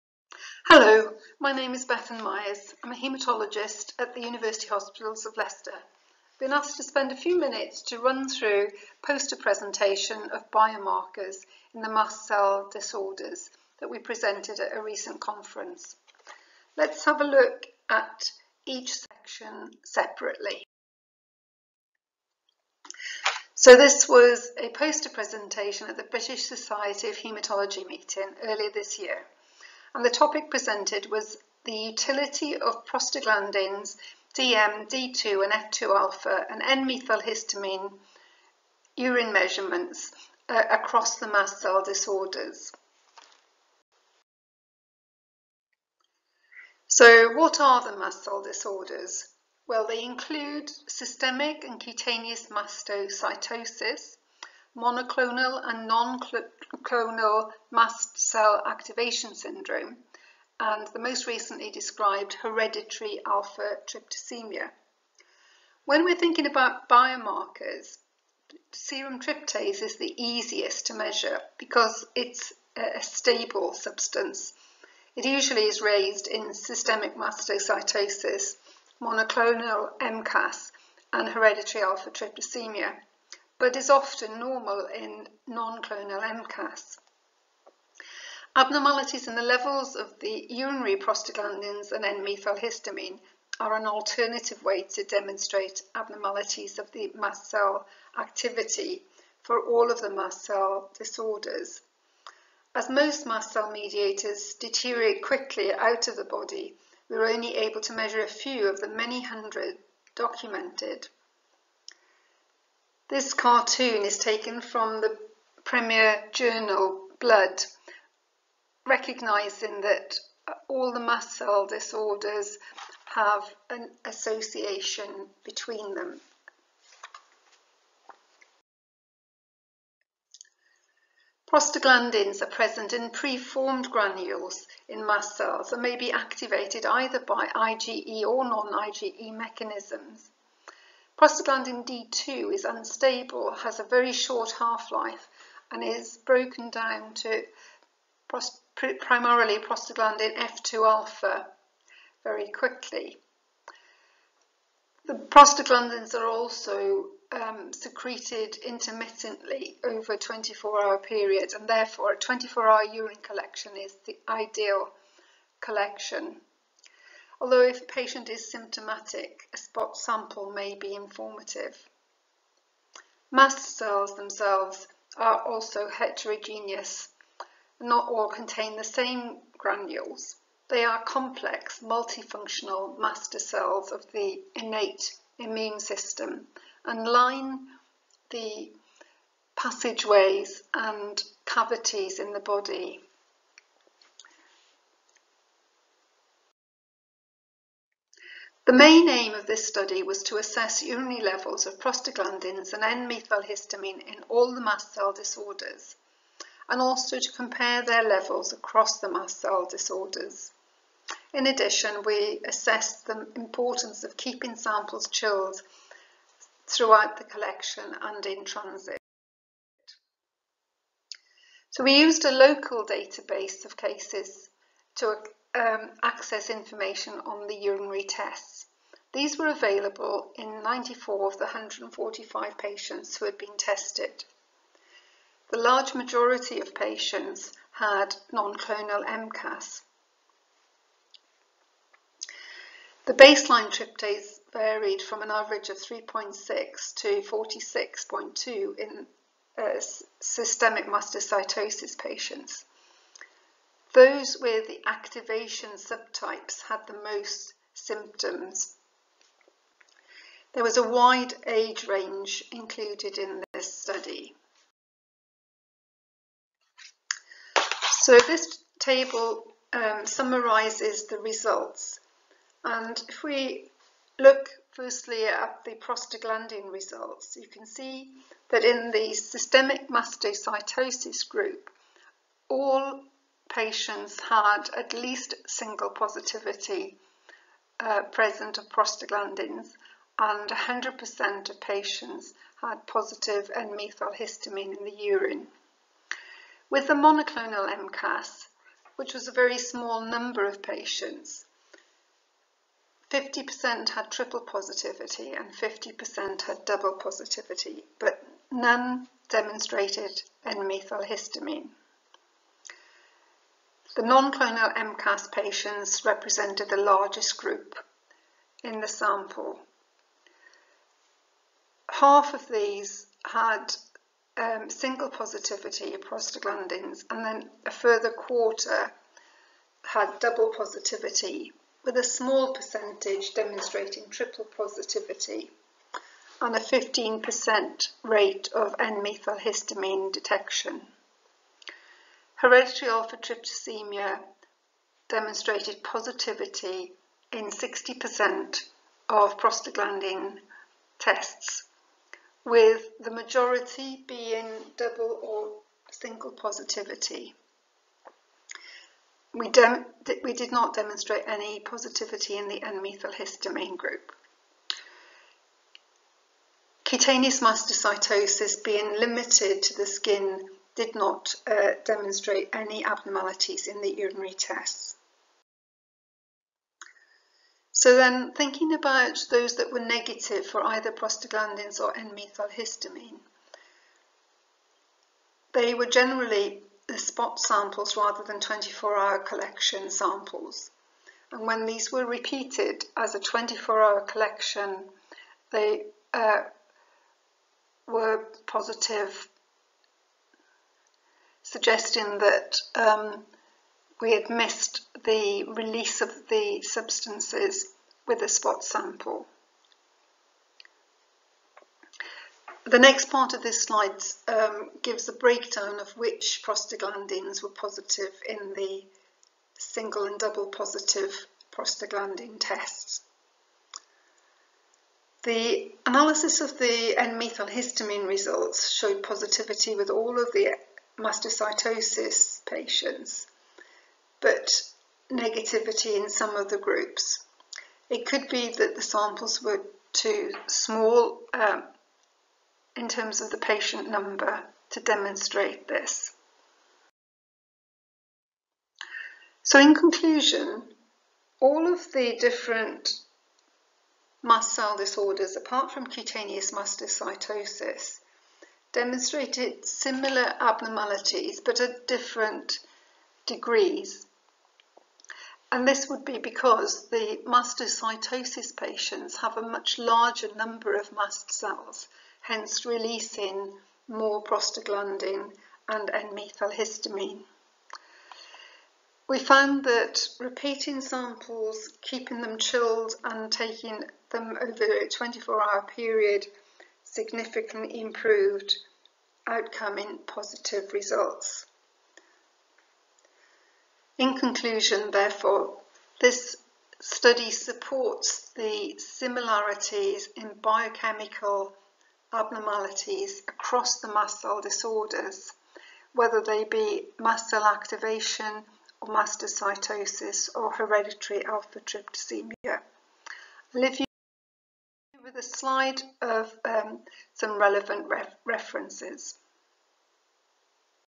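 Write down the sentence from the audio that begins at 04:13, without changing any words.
Those with the activation subtypes had the most symptoms there was a wide age range included in this study.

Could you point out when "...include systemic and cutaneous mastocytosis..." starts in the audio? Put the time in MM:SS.
00:50.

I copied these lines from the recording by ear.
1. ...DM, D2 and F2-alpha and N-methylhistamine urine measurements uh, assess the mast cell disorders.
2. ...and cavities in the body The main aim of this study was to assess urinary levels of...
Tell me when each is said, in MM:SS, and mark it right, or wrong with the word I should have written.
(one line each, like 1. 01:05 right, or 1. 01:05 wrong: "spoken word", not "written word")
1. 00:34 wrong: "across", not "assess"
2. 03:10 right.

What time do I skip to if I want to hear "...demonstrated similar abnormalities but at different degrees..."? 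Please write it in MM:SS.
07:38.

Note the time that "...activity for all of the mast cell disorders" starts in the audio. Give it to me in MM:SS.
01:38.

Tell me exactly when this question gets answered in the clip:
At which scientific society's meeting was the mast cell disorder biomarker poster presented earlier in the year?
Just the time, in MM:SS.
00:26.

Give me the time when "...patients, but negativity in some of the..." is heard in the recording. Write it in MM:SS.
07:12.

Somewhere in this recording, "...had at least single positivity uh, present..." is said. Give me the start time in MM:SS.
04:44.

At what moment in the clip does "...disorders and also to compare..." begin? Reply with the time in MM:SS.
03:25.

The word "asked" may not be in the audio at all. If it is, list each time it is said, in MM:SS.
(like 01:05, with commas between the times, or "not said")
00:06.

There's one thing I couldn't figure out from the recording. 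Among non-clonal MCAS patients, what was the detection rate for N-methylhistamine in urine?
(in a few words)
15%.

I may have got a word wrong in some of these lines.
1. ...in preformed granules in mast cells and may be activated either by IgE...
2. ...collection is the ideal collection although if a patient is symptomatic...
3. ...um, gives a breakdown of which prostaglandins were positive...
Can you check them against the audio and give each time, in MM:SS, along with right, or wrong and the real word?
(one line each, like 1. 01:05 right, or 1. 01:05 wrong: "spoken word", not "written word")
1. 02:12 right
2. 02:43 right
3. 06:54 right.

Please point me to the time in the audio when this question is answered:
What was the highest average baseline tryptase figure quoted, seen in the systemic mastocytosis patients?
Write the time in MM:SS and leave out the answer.
04:07.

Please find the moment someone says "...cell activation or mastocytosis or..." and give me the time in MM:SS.
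08:27.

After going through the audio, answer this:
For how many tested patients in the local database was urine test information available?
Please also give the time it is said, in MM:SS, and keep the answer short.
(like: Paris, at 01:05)
94, at 03:50.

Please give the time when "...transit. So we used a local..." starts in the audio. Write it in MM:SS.
03:38.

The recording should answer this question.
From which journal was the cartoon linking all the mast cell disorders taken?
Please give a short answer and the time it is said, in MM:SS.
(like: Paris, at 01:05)
Blood, at 01:57.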